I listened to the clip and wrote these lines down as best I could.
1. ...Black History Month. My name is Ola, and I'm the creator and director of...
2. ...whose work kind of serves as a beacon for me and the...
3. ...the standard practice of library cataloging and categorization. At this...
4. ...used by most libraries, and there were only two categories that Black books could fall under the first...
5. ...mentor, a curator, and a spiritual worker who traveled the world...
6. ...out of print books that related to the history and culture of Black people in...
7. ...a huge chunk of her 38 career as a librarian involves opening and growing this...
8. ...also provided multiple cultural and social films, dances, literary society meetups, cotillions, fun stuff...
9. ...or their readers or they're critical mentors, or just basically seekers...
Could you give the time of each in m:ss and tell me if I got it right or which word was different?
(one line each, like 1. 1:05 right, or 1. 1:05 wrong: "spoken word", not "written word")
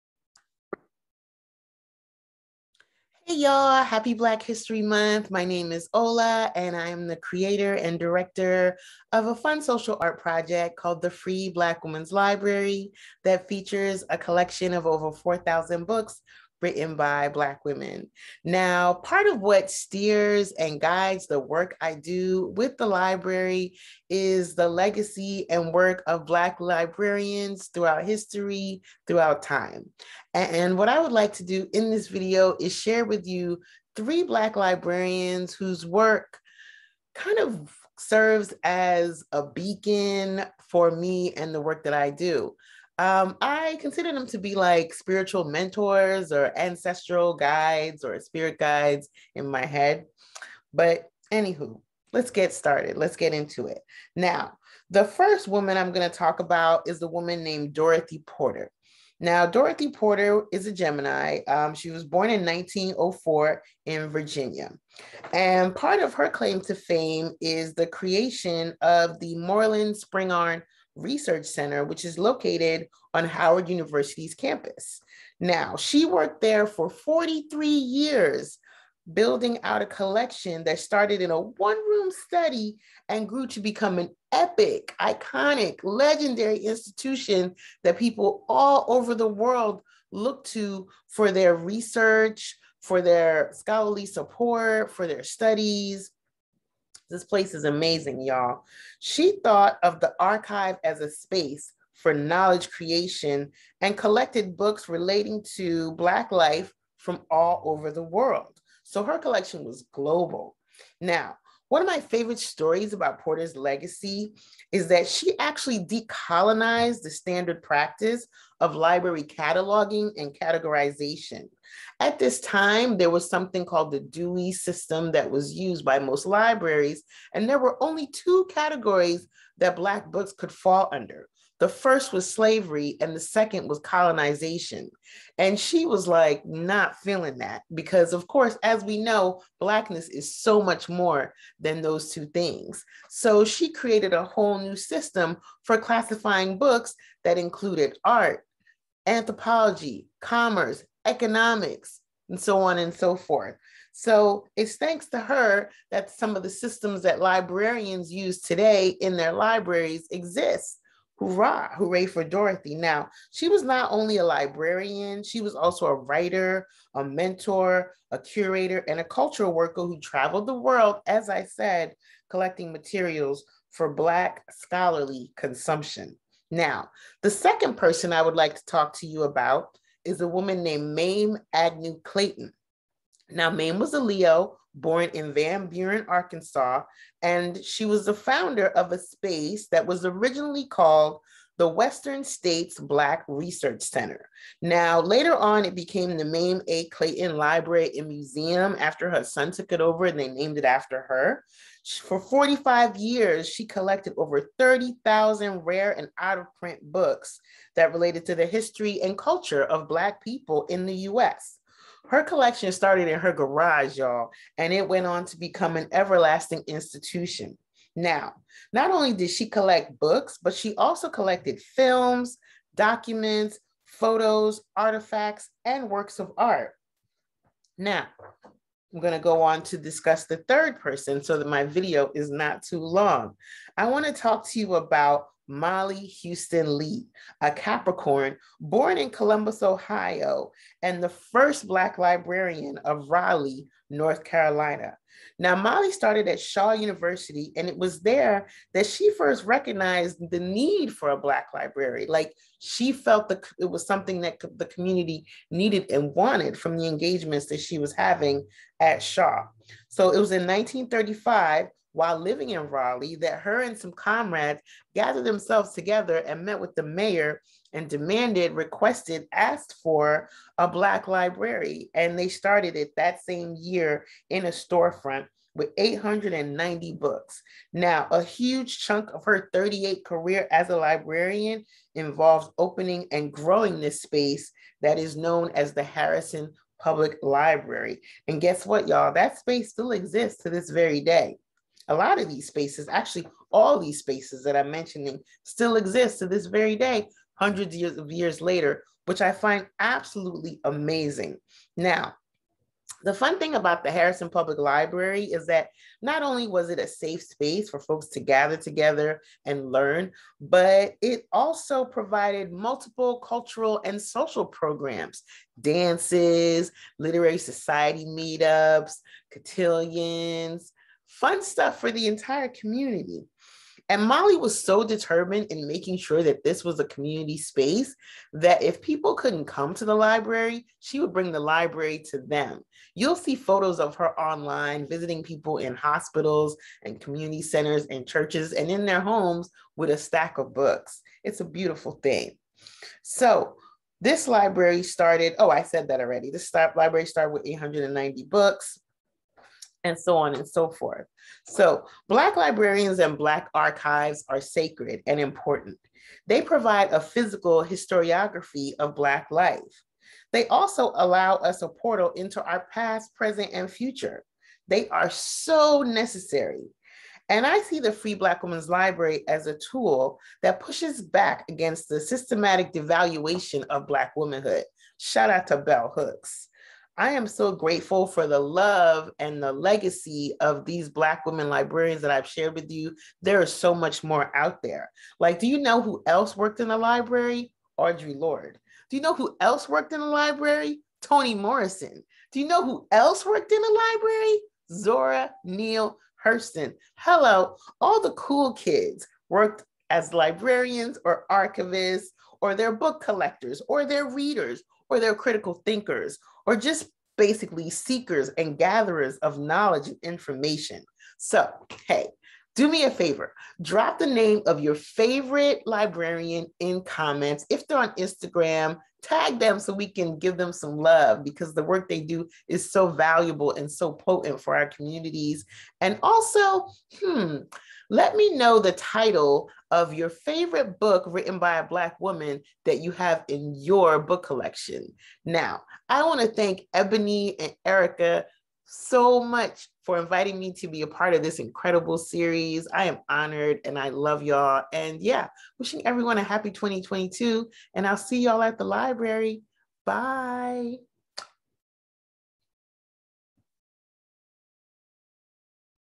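1. 0:04 right
2. 0:35 right
3. 1:57 right
4. 2:05 right
5. 2:47 wrong: "cultural", not "spiritual"
6. 3:26 right
7. 4:38 right
8. 5:11 wrong: "programs", not "films"
9. 6:43 wrong: "thinkers", not "mentors".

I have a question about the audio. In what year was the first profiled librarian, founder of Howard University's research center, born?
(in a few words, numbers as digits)
1904.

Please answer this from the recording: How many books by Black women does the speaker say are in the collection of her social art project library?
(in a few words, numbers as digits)
over 4,000.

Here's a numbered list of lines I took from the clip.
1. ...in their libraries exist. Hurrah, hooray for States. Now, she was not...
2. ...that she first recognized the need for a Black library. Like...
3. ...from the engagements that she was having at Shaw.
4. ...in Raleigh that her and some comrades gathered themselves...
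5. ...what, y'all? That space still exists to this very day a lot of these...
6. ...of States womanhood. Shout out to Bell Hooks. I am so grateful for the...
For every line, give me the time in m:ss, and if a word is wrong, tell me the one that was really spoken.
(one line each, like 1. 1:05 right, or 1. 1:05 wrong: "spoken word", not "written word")
1. 2:38 wrong: "Dorothy", not "States"
2. 4:08 right
3. 4:16 right
4. 4:22 right
5. 4:48 right
6. 6:13 wrong: "Black", not "States".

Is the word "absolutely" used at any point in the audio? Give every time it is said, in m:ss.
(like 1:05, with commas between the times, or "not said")
4:59.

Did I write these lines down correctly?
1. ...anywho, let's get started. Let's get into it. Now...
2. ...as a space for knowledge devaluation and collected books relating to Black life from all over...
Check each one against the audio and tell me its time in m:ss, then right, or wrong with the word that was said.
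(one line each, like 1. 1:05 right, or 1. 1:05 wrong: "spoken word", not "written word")
1. 0:51 right
2. 1:40 wrong: "creation", not "devaluation".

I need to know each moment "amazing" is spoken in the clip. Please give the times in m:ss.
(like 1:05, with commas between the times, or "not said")
1:37, 5:00.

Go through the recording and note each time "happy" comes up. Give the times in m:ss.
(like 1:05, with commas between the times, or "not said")
0:03, 7:26.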